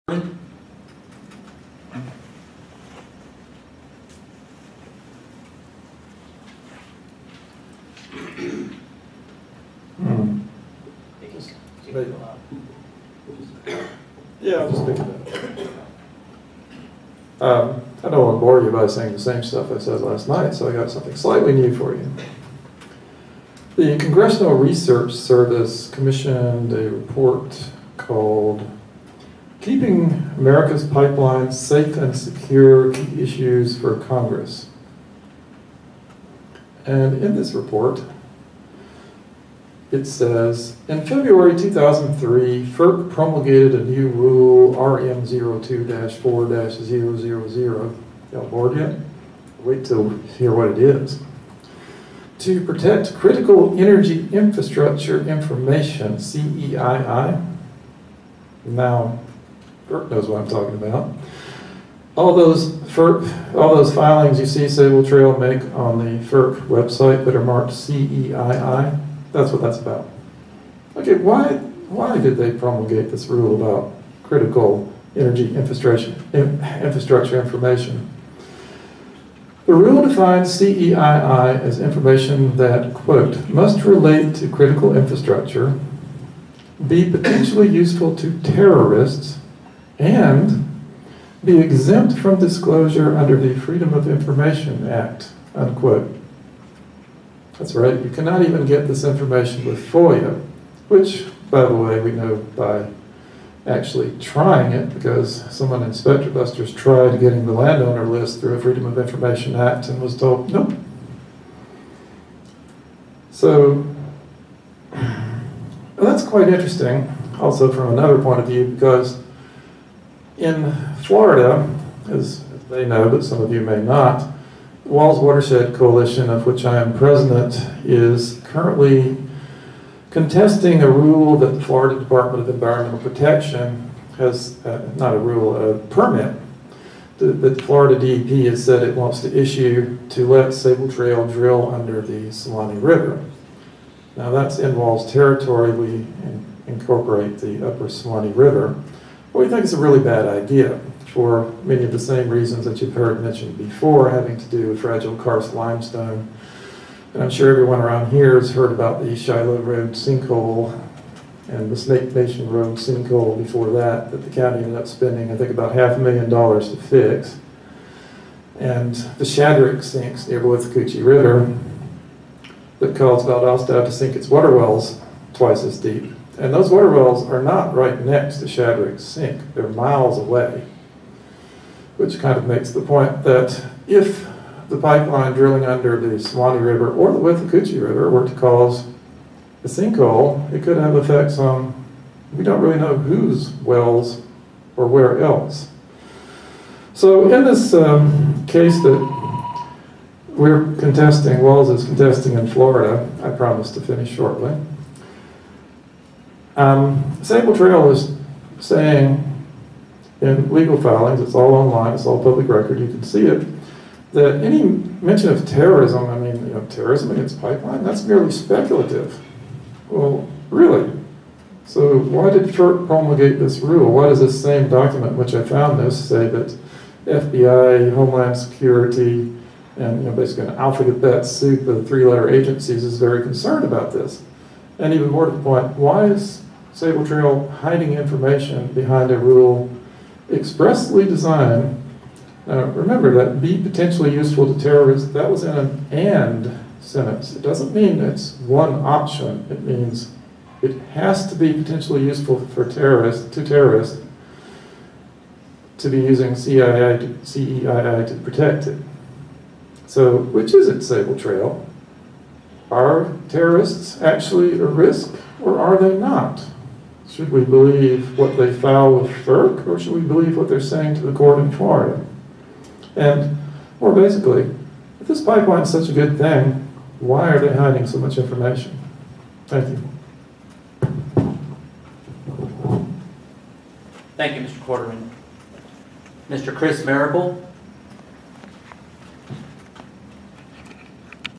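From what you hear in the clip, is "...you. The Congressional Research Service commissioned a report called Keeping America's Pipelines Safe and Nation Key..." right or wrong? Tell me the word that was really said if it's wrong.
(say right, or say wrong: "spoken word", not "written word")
wrong: "Secure", not "Nation".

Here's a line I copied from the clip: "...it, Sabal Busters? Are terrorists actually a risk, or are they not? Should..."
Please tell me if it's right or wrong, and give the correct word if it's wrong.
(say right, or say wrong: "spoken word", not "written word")
wrong: "Trail", not "Busters".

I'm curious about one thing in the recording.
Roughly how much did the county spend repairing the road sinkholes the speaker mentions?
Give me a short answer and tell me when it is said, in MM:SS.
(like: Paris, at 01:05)
half a million dollars, at 02:45.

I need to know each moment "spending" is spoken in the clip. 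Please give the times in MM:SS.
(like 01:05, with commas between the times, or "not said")
02:44.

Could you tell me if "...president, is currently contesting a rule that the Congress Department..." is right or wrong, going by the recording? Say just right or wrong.
wrong.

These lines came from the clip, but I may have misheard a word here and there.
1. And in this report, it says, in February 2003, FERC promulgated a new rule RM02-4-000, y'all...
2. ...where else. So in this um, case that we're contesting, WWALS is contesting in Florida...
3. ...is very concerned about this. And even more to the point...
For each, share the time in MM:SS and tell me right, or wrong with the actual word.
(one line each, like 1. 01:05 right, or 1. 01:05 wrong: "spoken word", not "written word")
1. 00:36 right
2. 03:14 right
3. 03:52 right.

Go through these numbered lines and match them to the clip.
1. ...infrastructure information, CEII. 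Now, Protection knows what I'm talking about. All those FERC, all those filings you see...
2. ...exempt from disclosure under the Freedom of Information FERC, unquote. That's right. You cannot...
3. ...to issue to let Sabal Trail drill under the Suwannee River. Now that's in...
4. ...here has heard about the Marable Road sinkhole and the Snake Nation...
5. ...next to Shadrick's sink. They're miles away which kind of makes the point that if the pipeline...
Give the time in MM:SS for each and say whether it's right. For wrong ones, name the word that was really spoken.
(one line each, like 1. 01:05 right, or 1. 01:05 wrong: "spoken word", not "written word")
1. 00:54 wrong: "FERC", not "Protection"
2. 01:31 wrong: "Act", not "FERC"
3. 02:19 right
4. 02:38 wrong: "Shiloh", not "Marable"
5. 02:57 right.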